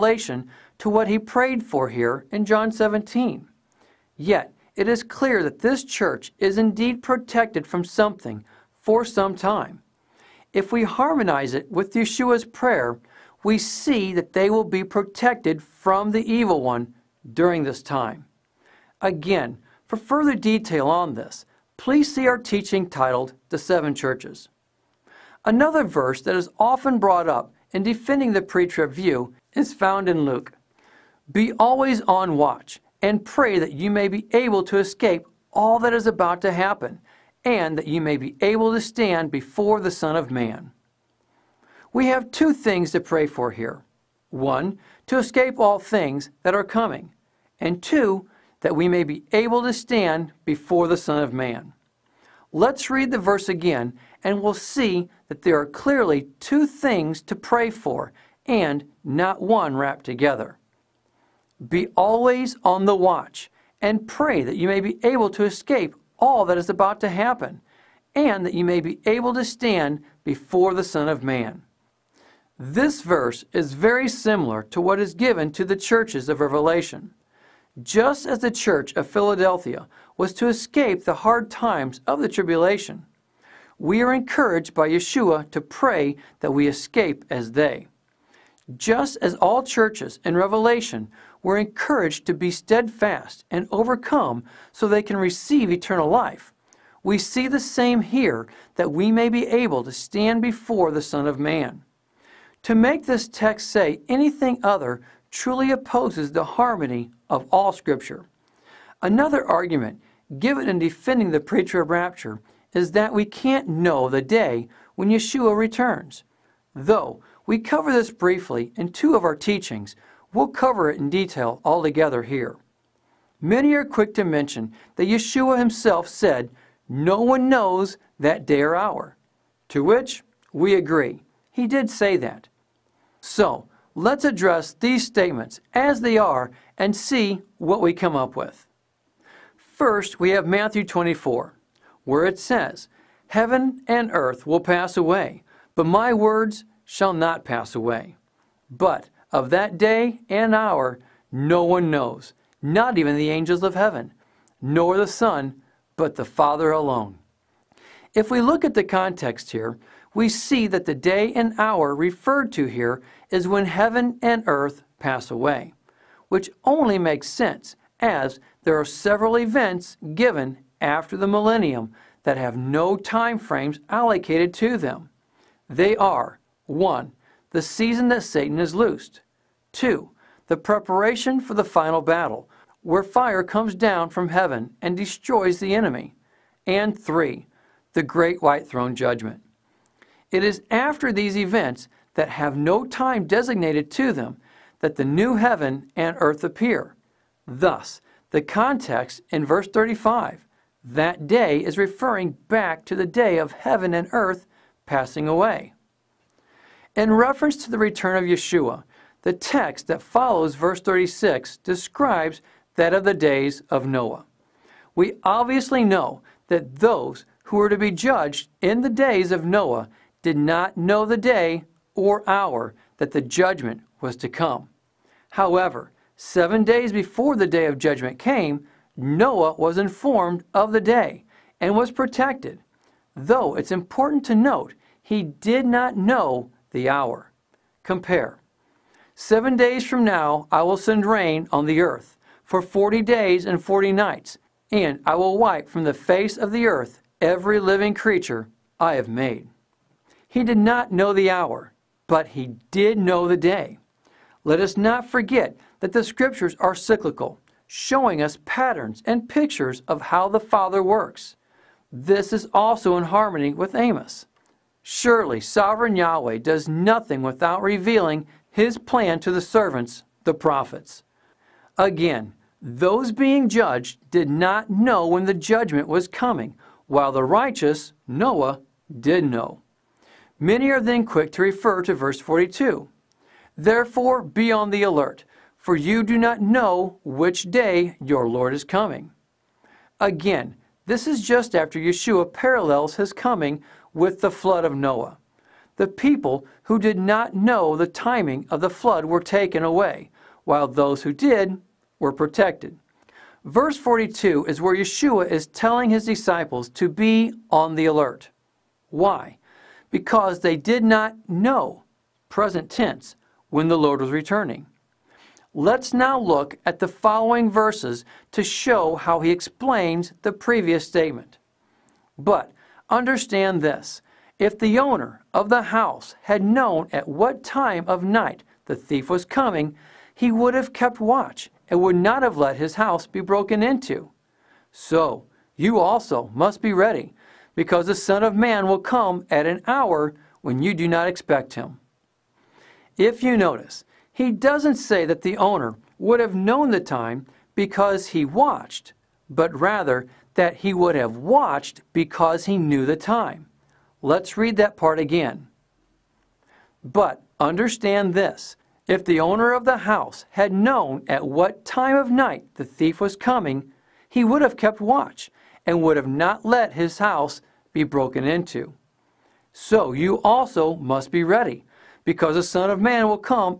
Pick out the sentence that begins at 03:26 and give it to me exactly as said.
In reference to the return of Yeshua, the text that follows verse 36 describes that of the days of Noah.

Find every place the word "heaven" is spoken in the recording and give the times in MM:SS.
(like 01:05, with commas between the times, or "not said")
02:23, 02:33, 02:43, 03:04, 03:15, 03:23.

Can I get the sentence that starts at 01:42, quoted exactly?
To make this text say anything other truly opposes the harmony of all Scripture.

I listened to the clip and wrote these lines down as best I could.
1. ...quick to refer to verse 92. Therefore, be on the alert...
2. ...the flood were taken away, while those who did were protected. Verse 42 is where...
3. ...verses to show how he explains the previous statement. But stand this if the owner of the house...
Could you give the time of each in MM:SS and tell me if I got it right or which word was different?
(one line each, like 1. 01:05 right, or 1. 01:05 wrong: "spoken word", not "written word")
1. 04:41 wrong: "42", not "92"
2. 04:58 right
3. 05:17 wrong: "understand", not "stand".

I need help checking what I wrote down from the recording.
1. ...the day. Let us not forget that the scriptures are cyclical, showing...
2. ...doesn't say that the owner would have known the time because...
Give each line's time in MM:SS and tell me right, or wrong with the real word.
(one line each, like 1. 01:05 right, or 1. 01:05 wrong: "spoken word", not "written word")
1. 04:13 right
2. 05:44 right.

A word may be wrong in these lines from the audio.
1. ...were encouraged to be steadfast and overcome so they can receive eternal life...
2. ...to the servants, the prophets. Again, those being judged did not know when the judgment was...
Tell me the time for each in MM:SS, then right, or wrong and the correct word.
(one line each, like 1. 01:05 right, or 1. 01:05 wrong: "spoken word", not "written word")
1. 01:31 right
2. 04:29 right.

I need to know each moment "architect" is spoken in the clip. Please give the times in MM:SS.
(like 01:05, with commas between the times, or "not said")
not said.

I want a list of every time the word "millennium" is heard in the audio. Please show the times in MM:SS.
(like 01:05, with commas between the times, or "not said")
02:51.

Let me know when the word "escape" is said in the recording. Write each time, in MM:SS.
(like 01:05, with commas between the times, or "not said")
00:34, 00:45, 01:05, 01:20, 01:26.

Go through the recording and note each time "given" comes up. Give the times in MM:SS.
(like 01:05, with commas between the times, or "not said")
01:15, 01:50, 02:50.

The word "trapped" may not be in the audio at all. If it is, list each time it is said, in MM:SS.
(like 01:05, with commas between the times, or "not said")
not said.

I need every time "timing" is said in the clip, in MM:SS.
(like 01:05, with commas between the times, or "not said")
04:57.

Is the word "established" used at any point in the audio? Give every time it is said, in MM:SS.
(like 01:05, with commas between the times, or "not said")
not said.